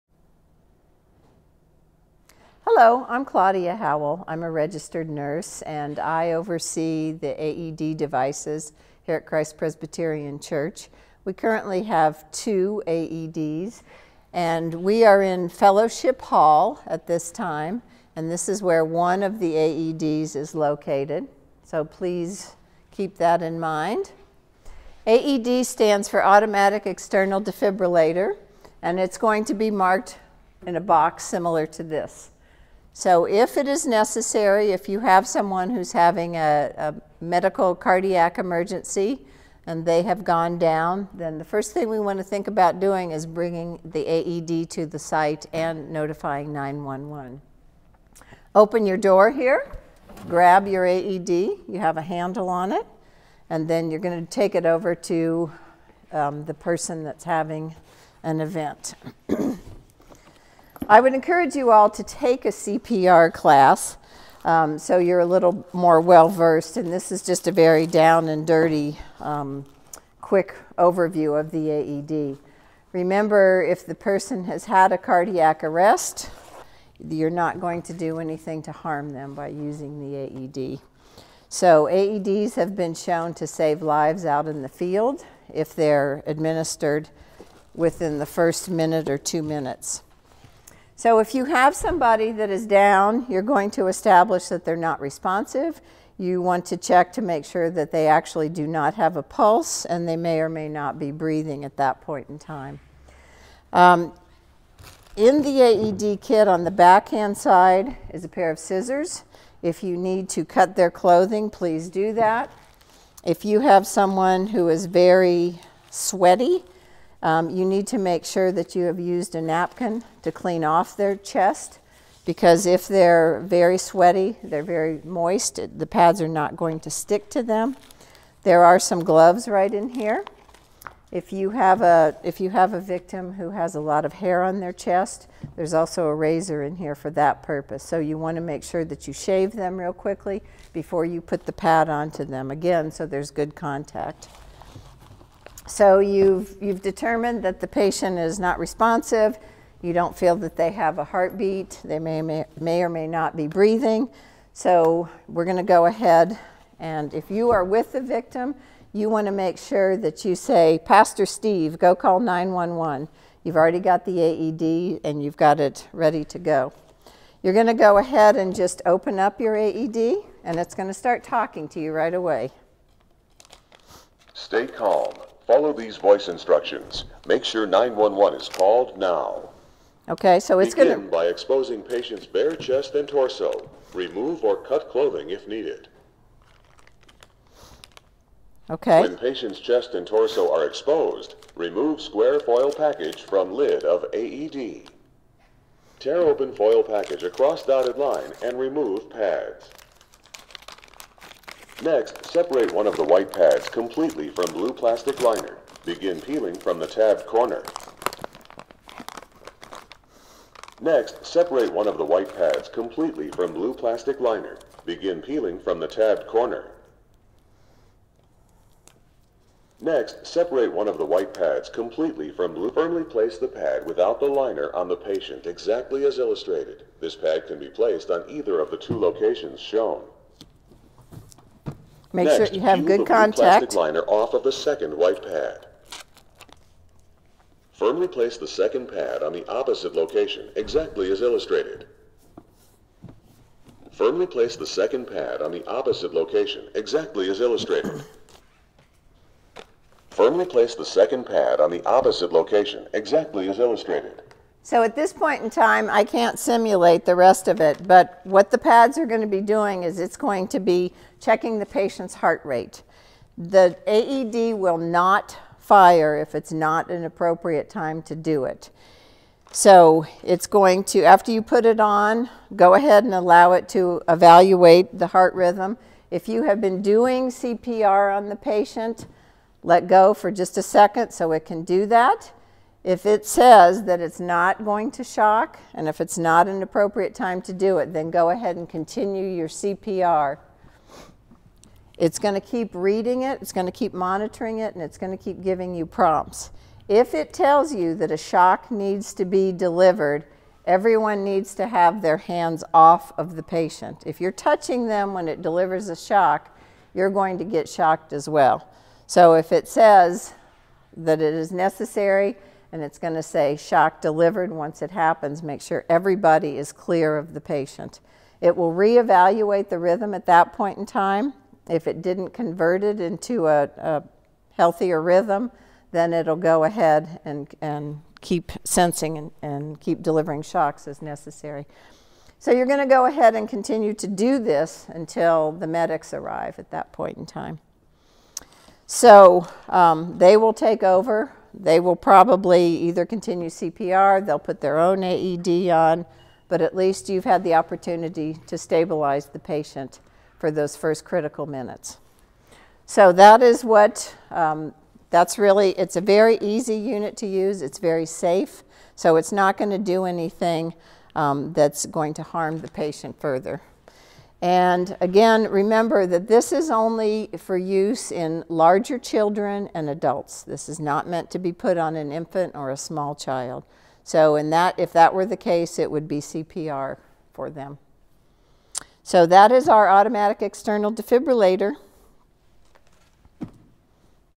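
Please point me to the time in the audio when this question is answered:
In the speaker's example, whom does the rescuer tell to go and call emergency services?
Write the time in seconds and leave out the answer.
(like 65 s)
160 s.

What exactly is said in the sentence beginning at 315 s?
Make sure everybody is clear of the patient.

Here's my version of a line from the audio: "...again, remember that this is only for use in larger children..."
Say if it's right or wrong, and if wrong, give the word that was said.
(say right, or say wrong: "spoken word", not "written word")
right.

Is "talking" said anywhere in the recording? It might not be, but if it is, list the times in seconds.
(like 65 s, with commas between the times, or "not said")
171 s.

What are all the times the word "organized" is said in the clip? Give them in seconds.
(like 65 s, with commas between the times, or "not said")
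not said.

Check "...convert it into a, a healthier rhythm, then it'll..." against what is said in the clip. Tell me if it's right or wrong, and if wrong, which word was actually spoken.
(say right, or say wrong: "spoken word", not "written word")
right.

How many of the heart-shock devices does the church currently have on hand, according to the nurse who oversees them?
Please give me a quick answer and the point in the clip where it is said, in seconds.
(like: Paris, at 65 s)
2, at 12 s.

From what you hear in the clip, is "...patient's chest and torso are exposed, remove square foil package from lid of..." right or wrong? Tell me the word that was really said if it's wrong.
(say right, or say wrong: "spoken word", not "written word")
right.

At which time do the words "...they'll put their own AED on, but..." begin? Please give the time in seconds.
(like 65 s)
344 s.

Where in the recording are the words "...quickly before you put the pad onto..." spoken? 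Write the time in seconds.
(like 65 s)
139 s.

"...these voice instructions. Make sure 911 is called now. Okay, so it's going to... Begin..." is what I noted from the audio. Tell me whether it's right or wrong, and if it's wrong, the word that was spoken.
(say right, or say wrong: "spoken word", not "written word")
right.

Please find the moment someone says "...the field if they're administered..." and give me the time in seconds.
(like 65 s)
84 s.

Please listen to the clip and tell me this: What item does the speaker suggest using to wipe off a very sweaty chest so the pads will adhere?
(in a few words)
napkin.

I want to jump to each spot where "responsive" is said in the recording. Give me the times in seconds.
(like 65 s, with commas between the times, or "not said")
94 s, 148 s.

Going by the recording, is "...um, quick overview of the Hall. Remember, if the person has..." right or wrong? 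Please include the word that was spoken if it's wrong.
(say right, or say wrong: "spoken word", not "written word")
wrong: "AED", not "Hall".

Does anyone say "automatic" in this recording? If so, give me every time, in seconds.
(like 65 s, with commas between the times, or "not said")
26 s, 379 s.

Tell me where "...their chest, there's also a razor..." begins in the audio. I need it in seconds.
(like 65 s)
134 s.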